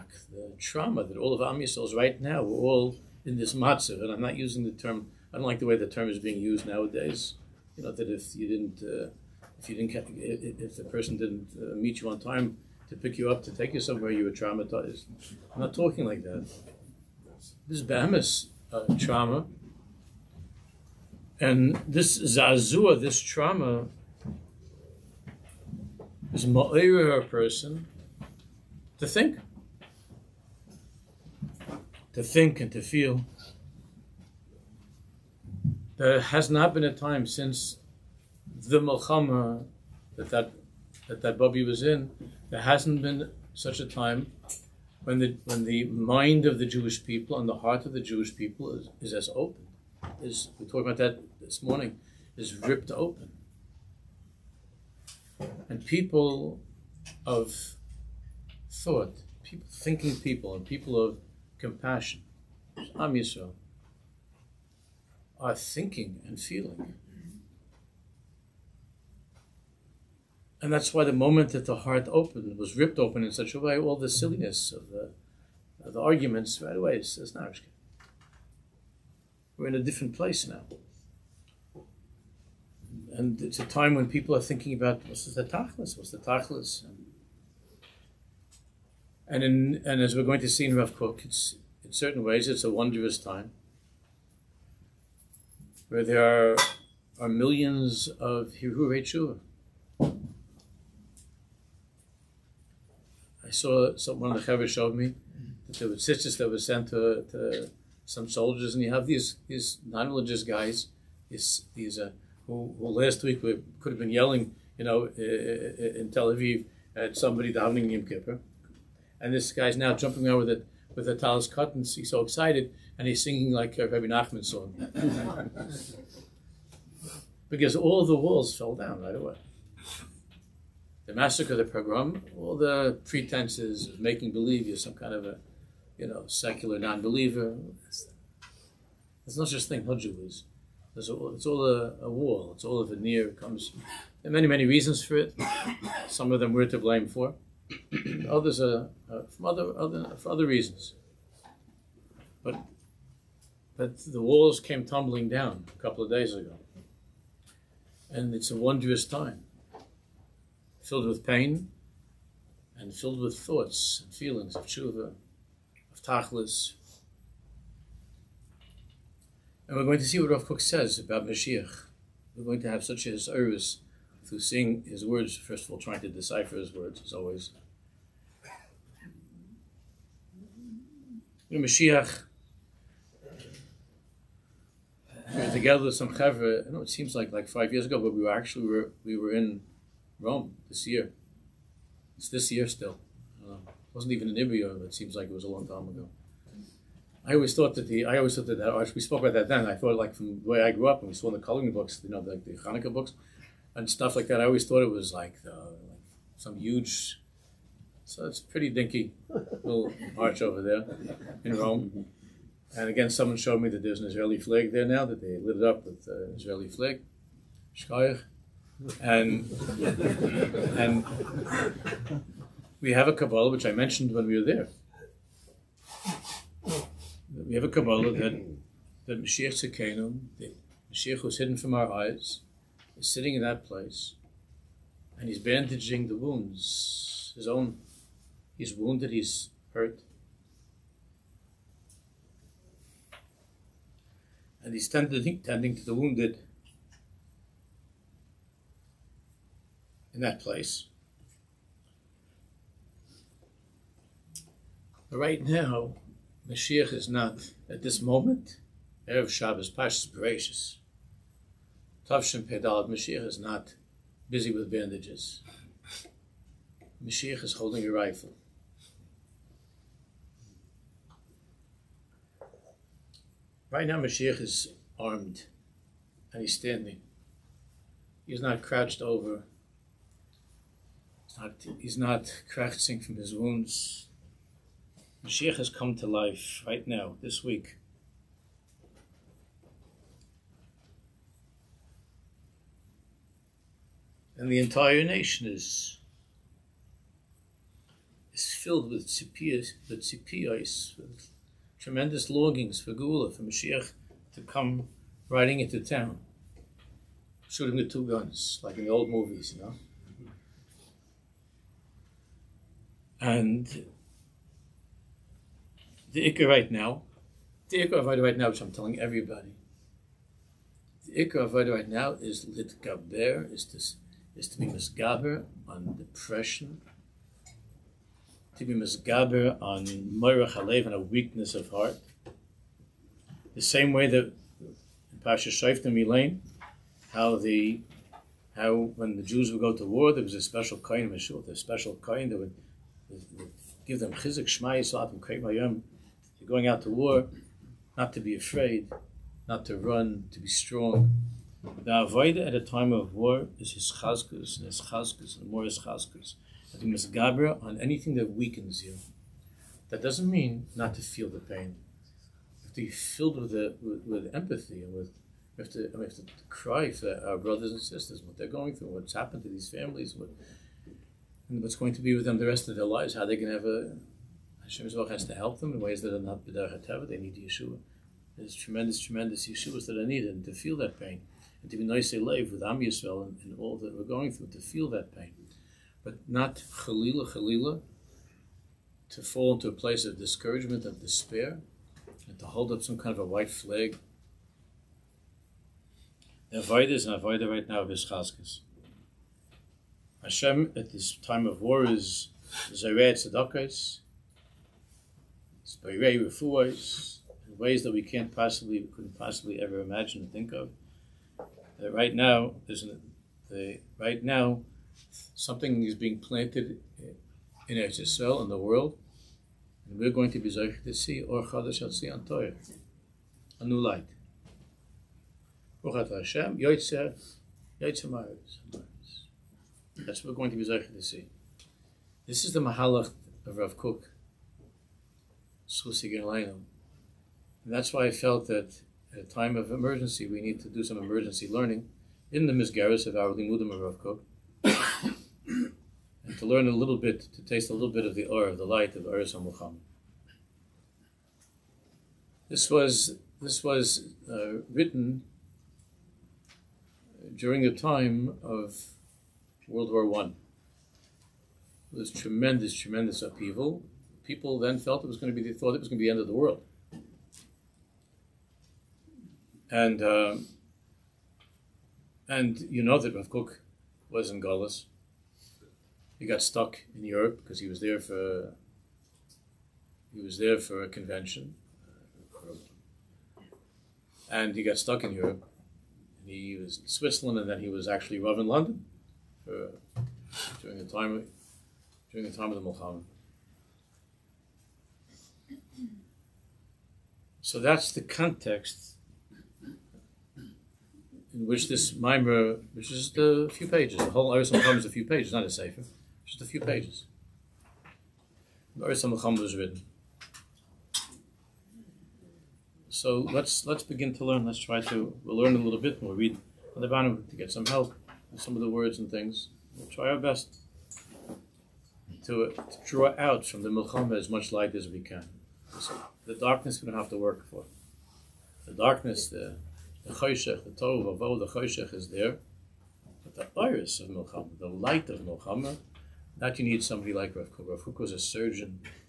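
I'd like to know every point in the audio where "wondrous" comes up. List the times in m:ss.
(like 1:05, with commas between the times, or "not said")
1:32, 2:38.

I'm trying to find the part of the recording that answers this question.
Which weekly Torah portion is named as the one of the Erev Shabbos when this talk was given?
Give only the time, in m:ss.
4:19.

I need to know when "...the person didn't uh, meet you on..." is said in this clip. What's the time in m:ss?
0:10.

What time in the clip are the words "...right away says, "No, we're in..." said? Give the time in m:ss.
1:16.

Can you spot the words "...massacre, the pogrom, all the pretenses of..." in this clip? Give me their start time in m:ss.
2:11.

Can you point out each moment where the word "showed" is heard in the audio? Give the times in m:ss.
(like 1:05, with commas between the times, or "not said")
1:44, 3:33.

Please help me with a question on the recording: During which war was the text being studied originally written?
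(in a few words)
World War One.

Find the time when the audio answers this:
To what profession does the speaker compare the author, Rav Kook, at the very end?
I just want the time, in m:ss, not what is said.
8:58.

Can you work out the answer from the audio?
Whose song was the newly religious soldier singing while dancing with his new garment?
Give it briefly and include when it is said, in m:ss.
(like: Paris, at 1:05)
Rabbi Nachman, at 2:03.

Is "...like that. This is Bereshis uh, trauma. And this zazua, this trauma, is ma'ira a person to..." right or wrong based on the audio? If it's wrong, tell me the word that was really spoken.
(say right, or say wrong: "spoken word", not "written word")
wrong: "Bahamas", not "Bereshis".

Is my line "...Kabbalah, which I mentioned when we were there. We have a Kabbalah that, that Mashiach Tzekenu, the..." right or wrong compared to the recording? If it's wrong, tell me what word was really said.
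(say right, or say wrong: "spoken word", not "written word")
right.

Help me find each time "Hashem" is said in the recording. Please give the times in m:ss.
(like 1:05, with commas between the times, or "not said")
6:14, 6:40, 7:06.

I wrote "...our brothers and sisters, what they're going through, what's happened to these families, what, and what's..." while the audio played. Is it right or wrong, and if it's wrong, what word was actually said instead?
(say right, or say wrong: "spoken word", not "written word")
right.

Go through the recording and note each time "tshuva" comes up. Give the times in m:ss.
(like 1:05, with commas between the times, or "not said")
1:39, 2:44.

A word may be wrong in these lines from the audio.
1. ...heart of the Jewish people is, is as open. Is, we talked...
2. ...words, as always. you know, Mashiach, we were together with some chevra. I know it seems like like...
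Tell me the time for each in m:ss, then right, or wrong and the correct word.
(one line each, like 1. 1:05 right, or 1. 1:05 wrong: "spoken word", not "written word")
1. 0:47 right
2. 2:56 right.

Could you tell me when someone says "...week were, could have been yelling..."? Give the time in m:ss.
1:53.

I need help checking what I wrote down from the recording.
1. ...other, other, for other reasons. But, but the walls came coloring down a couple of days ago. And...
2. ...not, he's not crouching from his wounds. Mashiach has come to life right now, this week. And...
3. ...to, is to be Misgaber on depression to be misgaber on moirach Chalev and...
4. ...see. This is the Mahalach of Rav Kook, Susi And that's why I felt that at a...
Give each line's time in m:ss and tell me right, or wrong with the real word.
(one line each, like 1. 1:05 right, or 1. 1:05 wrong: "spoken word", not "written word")
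1. 2:29 wrong: "tumbling", not "coloring"
2. 4:41 right
3. 5:23 right
4. 7:11 right.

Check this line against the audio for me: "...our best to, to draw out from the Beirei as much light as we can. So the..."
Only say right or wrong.
wrong.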